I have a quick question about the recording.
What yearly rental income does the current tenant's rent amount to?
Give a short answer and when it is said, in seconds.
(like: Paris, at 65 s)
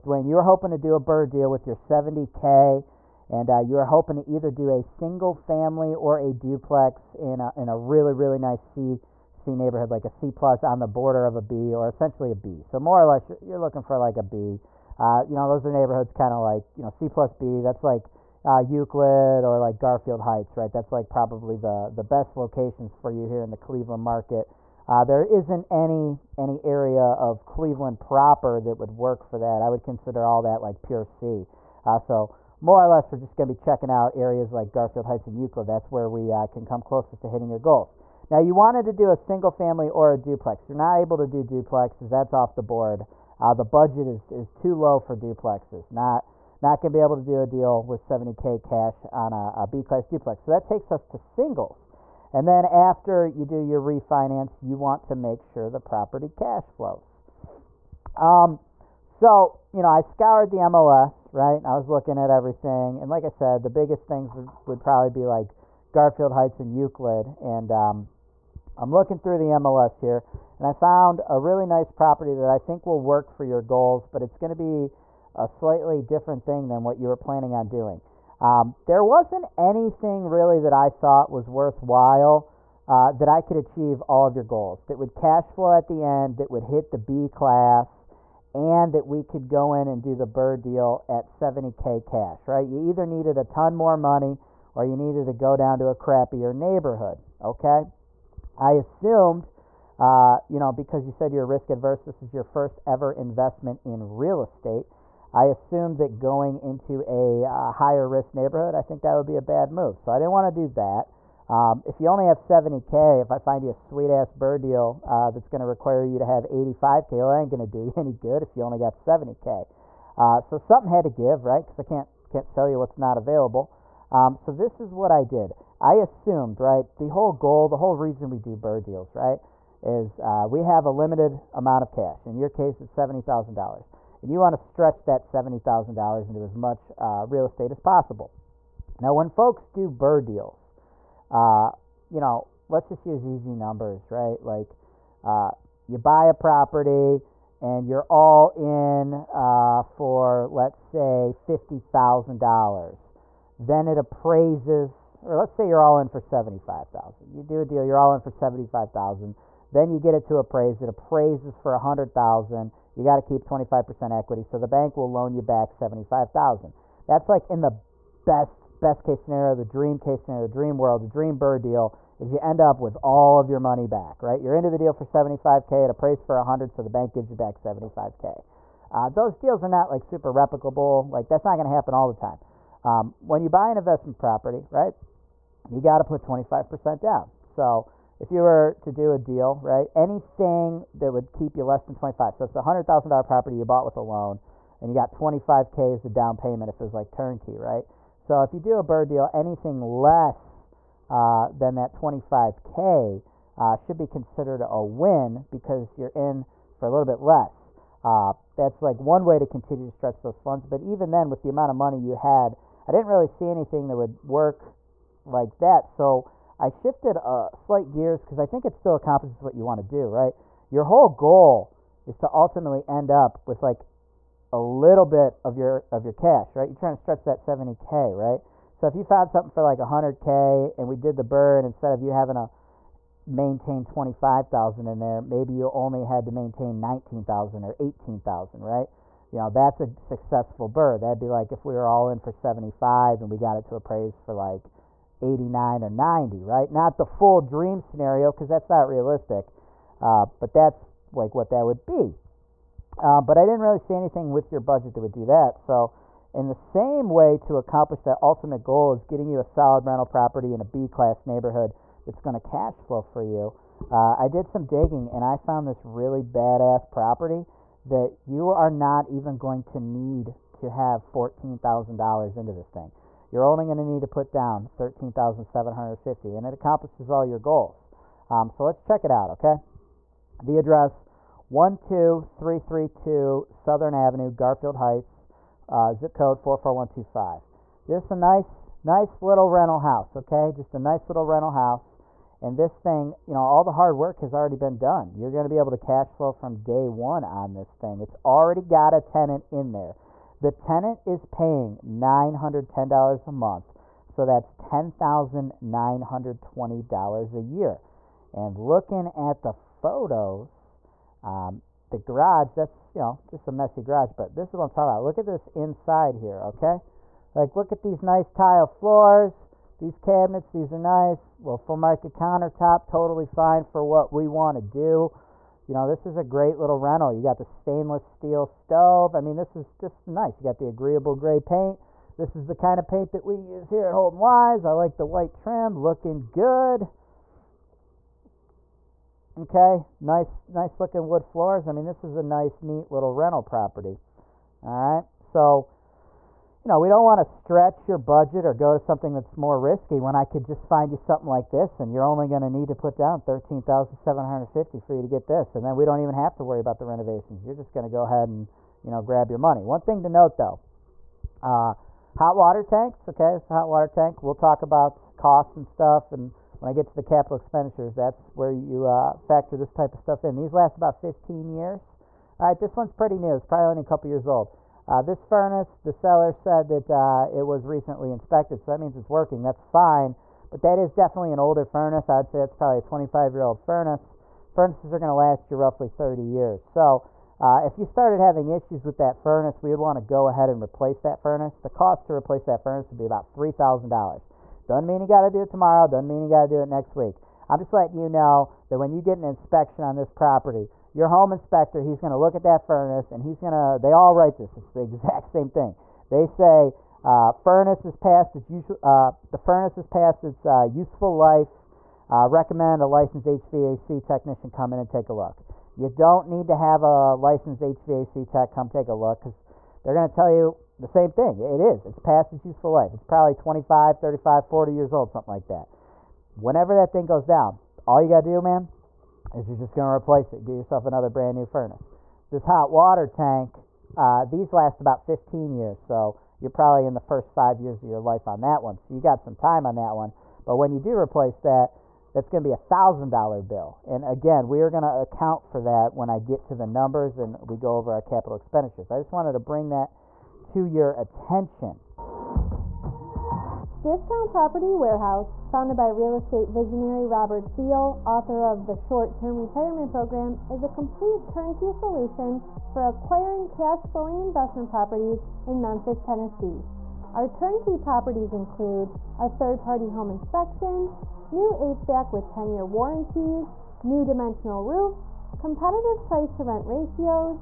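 $10,920, at 304 s.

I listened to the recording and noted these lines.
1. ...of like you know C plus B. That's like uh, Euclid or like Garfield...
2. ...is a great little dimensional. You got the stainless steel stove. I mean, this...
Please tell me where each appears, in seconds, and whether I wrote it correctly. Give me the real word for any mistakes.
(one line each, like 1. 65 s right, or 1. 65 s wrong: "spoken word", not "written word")
1. 16 s right
2. 326 s wrong: "rental", not "dimensional".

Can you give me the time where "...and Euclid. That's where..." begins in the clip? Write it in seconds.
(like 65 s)
35 s.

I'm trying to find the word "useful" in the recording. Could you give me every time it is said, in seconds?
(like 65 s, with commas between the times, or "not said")
410 s, 422 s.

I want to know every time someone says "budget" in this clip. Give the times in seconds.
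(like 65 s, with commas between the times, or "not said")
43 s, 254 s, 347 s.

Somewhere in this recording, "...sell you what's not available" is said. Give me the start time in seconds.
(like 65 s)
122 s.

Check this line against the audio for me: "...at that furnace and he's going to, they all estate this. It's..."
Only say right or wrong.
wrong.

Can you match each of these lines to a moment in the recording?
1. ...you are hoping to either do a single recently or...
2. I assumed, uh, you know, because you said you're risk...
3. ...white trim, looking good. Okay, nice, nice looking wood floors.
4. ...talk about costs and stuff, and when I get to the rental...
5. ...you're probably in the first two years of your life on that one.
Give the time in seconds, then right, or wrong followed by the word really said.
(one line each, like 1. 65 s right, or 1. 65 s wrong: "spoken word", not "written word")
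1. 3 s wrong: "family", not "recently"
2. 98 s right
3. 335 s right
4. 364 s wrong: "capital", not "rental"
5. 436 s wrong: "five", not "two".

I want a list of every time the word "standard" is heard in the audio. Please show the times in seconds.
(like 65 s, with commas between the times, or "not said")
not said.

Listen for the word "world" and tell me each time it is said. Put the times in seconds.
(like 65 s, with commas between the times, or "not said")
170 s.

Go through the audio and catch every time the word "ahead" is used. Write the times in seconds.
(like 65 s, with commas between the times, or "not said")
358 s, 390 s.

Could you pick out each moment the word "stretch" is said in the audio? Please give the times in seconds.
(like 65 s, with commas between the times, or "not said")
134 s, 209 s, 227 s, 347 s.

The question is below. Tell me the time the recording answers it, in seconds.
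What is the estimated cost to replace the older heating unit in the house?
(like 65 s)
393 s.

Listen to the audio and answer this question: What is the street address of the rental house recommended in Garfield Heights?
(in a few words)
12332 Southern Avenue.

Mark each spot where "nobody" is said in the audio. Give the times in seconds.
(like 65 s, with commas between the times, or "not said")
not said.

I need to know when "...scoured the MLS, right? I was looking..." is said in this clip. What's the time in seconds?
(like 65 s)
60 s.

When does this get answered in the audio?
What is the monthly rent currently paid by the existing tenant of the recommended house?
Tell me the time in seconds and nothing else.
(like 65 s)
301 s.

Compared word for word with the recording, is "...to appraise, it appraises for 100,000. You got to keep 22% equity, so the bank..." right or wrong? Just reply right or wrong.
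wrong.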